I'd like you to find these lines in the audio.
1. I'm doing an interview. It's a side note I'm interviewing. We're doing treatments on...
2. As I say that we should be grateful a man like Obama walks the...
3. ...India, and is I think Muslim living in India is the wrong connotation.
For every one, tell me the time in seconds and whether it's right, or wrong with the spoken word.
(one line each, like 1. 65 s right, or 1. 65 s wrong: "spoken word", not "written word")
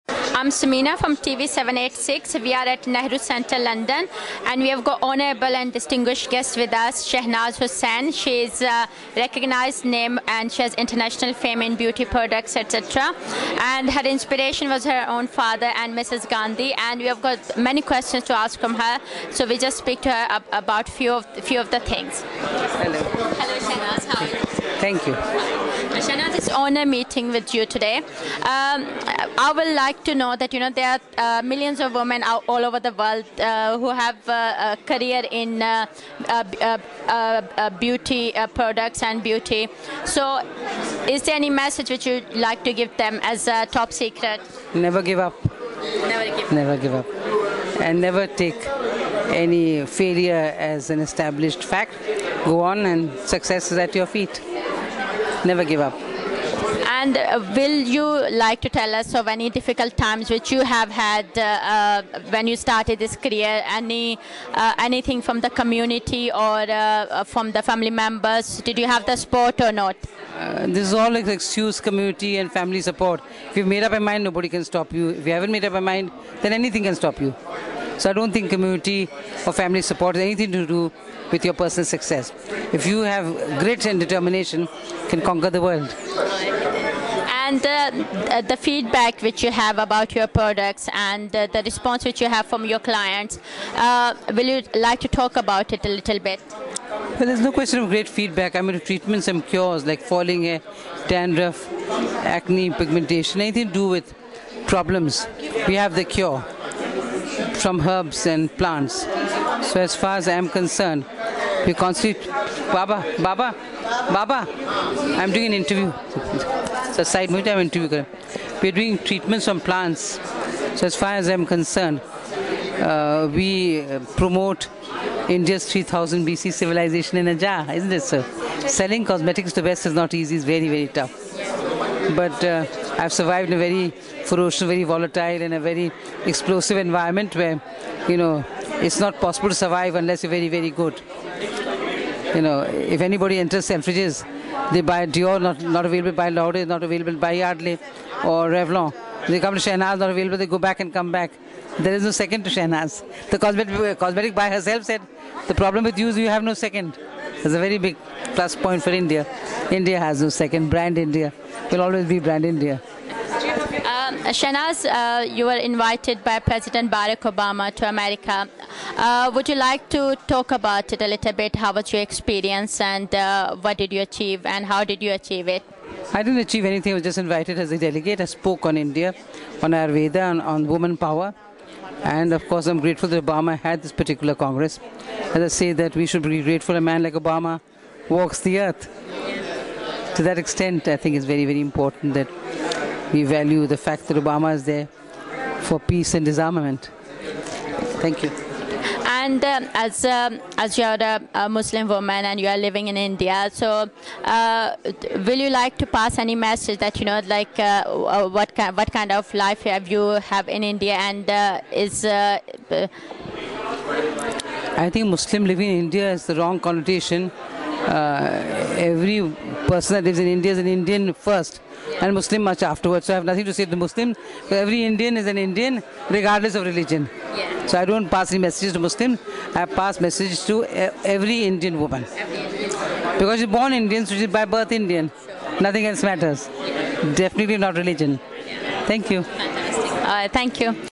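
1. 115 s right
2. 185 s right
3. 210 s right.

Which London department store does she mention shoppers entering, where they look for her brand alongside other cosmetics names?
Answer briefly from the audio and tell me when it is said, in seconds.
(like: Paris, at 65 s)
Selfridges, at 143 s.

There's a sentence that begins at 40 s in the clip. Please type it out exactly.
So, is there any message which you like to give them as a top secret?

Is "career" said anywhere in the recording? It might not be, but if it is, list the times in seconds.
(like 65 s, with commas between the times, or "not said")
34 s, 63 s.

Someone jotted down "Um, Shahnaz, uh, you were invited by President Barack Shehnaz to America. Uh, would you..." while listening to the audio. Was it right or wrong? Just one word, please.
wrong.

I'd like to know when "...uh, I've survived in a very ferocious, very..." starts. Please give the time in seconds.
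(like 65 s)
132 s.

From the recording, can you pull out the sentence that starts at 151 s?
There is no second to Shahnaz.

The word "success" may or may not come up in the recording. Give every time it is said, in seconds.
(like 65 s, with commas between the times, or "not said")
53 s, 81 s.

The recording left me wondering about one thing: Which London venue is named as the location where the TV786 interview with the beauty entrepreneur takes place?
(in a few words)
Nehru Centre.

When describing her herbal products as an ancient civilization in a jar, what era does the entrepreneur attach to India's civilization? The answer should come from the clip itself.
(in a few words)
3000 BC.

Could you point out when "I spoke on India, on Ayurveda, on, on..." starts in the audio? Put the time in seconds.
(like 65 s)
178 s.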